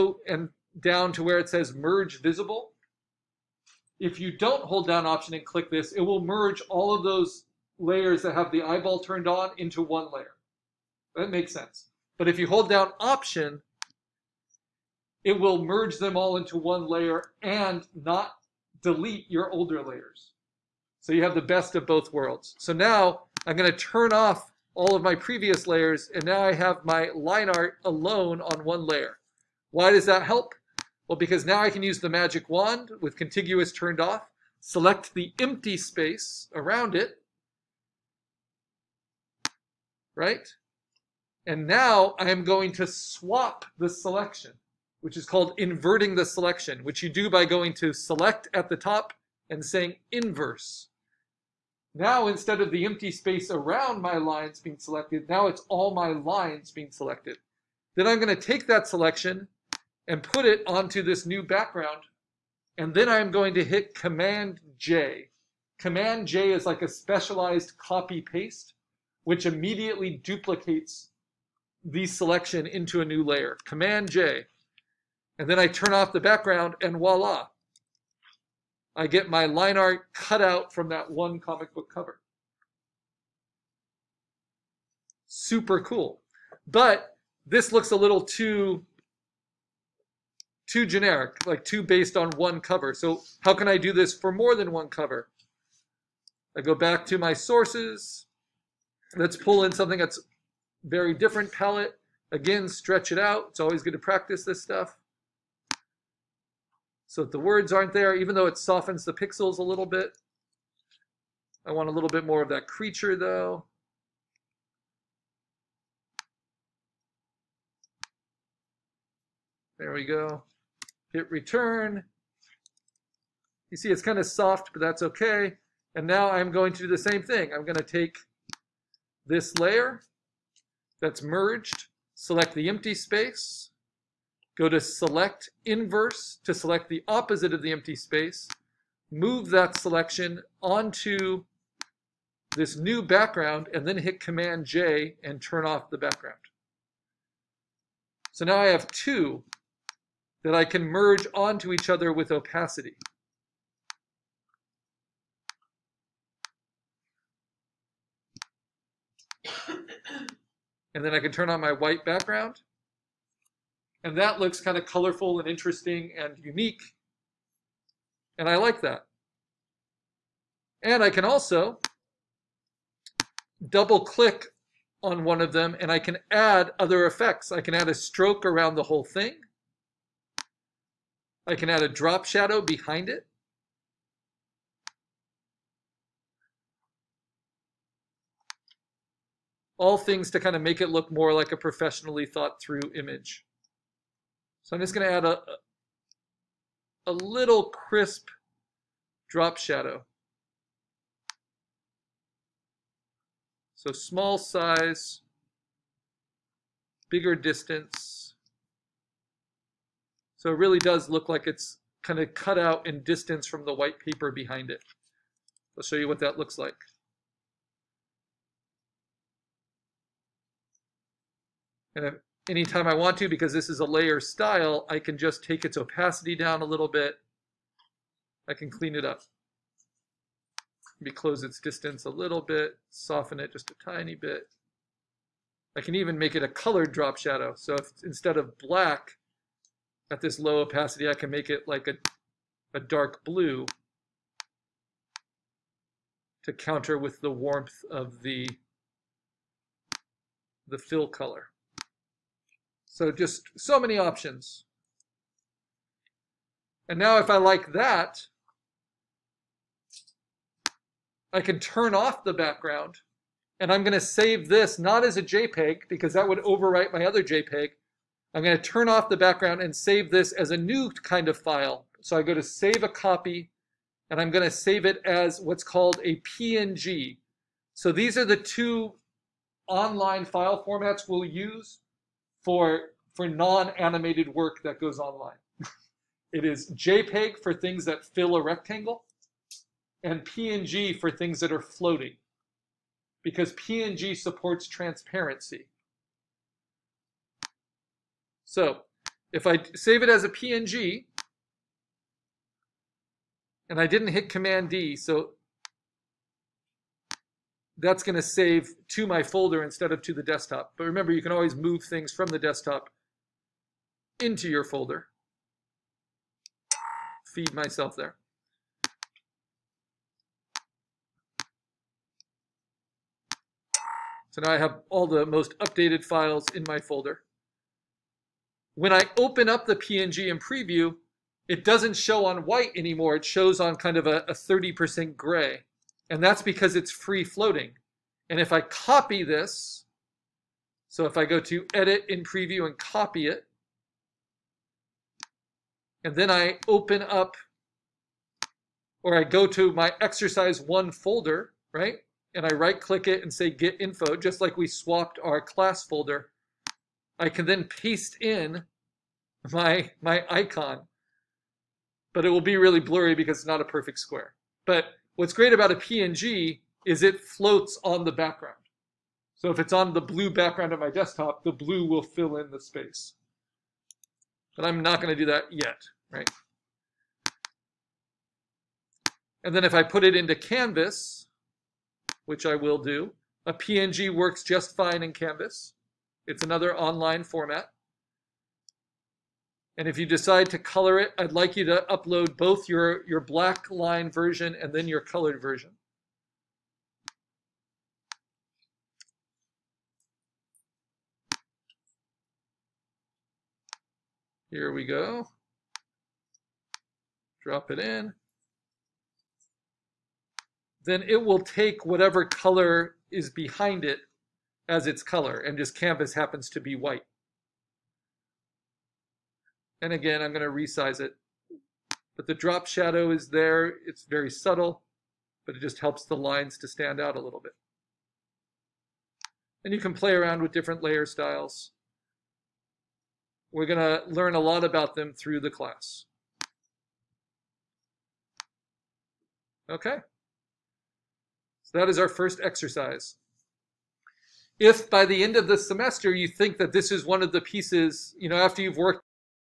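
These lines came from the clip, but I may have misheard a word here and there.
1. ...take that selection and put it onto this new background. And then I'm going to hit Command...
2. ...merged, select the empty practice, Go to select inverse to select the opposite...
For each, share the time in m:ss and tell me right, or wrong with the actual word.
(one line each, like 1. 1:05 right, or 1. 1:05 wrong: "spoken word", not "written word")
1. 0:58 right
2. 2:11 wrong: "space", not "practice".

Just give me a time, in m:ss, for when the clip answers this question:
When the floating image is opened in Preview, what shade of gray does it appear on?
5:34.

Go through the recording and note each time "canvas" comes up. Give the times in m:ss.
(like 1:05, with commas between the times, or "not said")
6:20, 6:25, 6:55.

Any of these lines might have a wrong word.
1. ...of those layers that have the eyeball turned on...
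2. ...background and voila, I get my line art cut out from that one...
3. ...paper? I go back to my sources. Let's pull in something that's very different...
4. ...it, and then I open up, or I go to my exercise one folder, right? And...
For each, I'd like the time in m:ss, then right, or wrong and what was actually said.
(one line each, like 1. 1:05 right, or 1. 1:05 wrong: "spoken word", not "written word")
1. 0:06 right
2. 1:16 right
3. 1:34 wrong: "cover", not "paper"
4. 5:43 right.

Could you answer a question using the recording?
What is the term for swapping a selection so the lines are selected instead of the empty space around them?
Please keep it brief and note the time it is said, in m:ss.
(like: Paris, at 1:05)
Inverting the selection, at 0:45.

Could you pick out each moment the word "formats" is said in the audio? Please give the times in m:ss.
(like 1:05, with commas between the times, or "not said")
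4:40, 6:27.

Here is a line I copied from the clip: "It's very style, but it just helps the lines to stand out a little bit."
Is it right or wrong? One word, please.
wrong.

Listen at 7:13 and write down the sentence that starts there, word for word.
We're going to learn a lot about them through the class.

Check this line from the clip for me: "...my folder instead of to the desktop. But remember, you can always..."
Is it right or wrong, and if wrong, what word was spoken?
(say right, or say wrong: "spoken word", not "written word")
right.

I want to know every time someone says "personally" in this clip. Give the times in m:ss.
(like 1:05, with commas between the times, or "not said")
not said.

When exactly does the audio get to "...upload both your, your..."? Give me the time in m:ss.
6:31.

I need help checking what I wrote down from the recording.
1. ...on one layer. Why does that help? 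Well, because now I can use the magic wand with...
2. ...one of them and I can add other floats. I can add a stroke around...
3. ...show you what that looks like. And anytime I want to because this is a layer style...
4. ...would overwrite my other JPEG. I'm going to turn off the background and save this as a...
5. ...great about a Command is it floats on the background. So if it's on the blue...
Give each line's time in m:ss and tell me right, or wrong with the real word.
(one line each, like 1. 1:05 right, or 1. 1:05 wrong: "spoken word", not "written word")
1. 0:28 right
2. 2:55 wrong: "effects", not "floats"
3. 3:35 right
4. 4:26 right
5. 6:05 wrong: "PNG", not "Command".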